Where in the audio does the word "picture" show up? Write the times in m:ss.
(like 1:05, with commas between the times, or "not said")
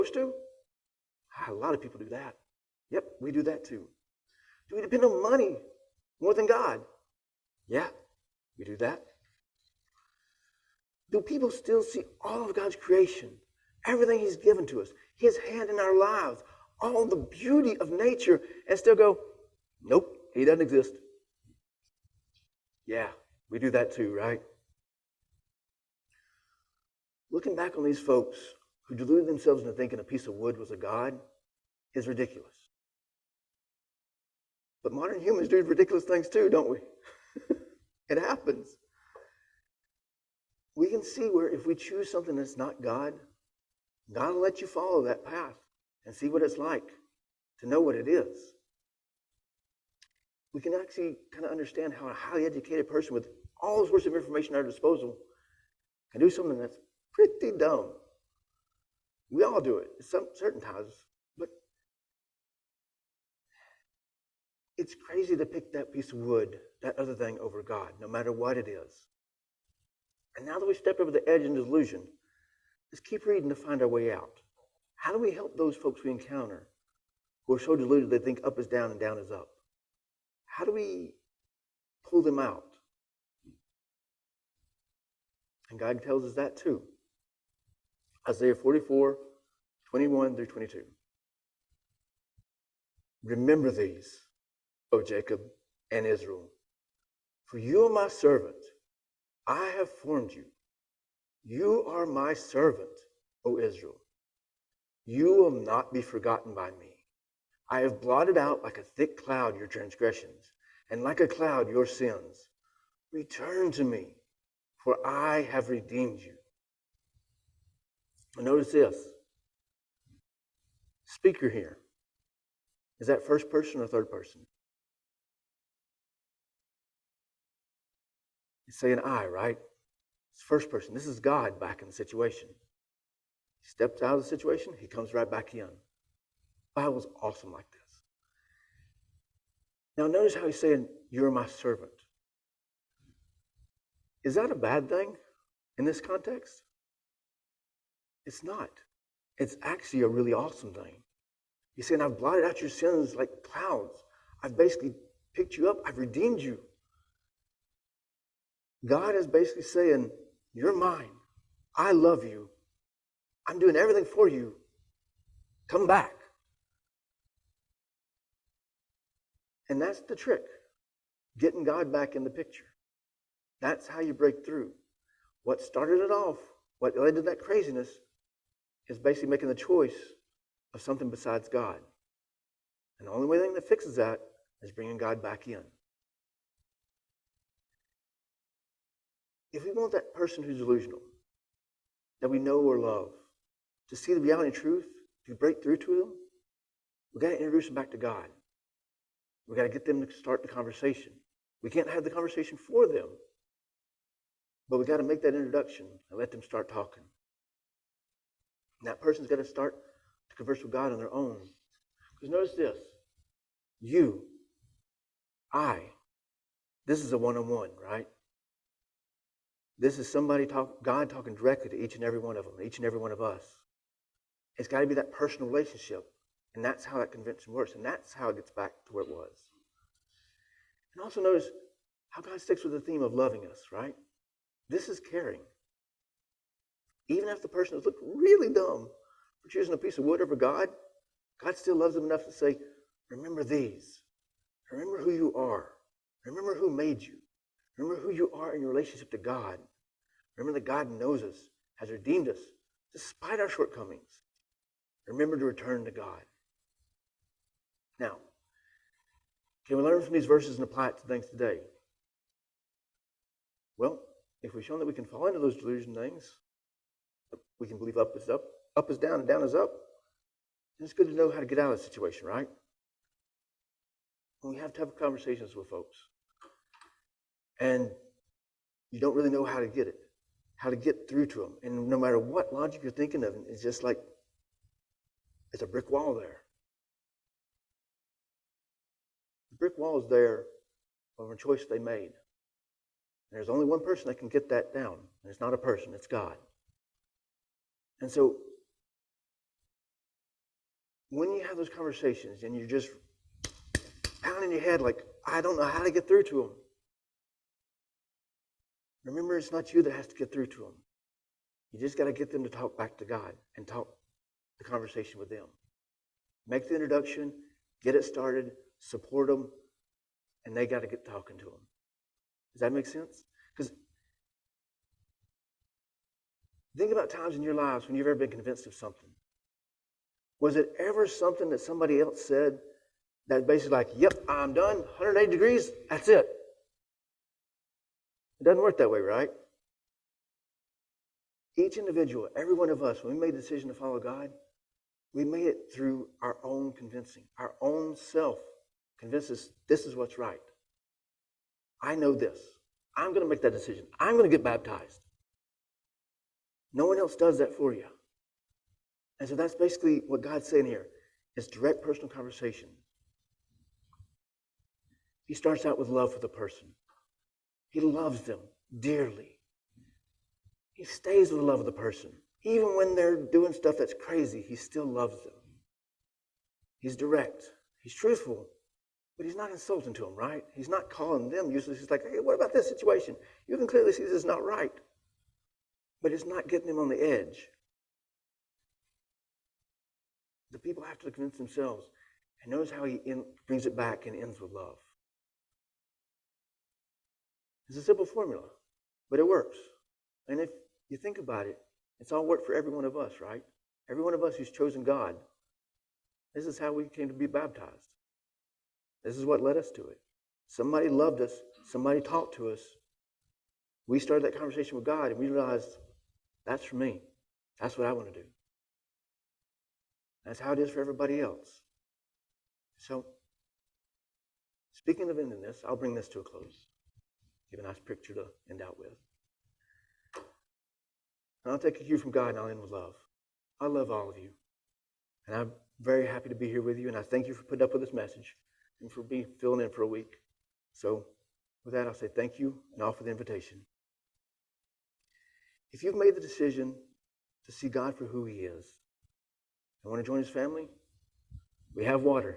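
2:52, 7:07.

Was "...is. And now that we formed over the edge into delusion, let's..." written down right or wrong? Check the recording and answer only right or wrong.
wrong.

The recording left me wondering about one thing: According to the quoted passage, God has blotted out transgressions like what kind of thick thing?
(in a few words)
a cloud.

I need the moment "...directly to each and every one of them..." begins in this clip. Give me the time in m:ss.
3:41.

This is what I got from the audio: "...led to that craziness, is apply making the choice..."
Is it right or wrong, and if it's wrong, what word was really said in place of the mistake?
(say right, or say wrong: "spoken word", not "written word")
wrong: "basically", not "apply".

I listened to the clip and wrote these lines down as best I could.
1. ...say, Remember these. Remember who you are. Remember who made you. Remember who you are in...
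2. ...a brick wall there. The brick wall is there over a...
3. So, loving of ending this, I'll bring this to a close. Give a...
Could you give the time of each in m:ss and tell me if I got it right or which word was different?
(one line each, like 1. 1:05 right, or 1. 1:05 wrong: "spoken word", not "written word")
1. 4:02 right
2. 4:45 right
3. 7:02 wrong: "speaking", not "loving".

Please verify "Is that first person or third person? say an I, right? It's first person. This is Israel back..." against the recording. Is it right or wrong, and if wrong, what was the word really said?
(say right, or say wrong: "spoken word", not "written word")
wrong: "God", not "Israel".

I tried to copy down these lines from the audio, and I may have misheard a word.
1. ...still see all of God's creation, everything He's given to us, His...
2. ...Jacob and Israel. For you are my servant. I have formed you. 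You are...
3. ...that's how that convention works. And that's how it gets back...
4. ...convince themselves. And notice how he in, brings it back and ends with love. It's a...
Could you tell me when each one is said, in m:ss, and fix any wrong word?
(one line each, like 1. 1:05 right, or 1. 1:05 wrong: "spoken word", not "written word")
1. 0:11 right
2. 1:35 right
3. 3:46 right
4. 6:31 right.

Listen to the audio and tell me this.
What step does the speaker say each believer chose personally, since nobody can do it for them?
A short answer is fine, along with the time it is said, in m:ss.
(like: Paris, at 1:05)
get baptized, at 5:54.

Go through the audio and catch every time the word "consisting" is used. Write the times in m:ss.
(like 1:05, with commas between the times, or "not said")
not said.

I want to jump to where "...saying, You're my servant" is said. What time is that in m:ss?
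2:20.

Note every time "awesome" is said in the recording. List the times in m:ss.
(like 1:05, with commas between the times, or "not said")
2:17, 2:30.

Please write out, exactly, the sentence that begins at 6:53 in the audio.
We started that conversation with God and we realized that's for me.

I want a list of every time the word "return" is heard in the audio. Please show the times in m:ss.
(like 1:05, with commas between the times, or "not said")
1:53, 4:15.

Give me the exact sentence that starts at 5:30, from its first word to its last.
Was it ever something that somebody else said that basically like, yep, I'm done, 180 degrees, that's it.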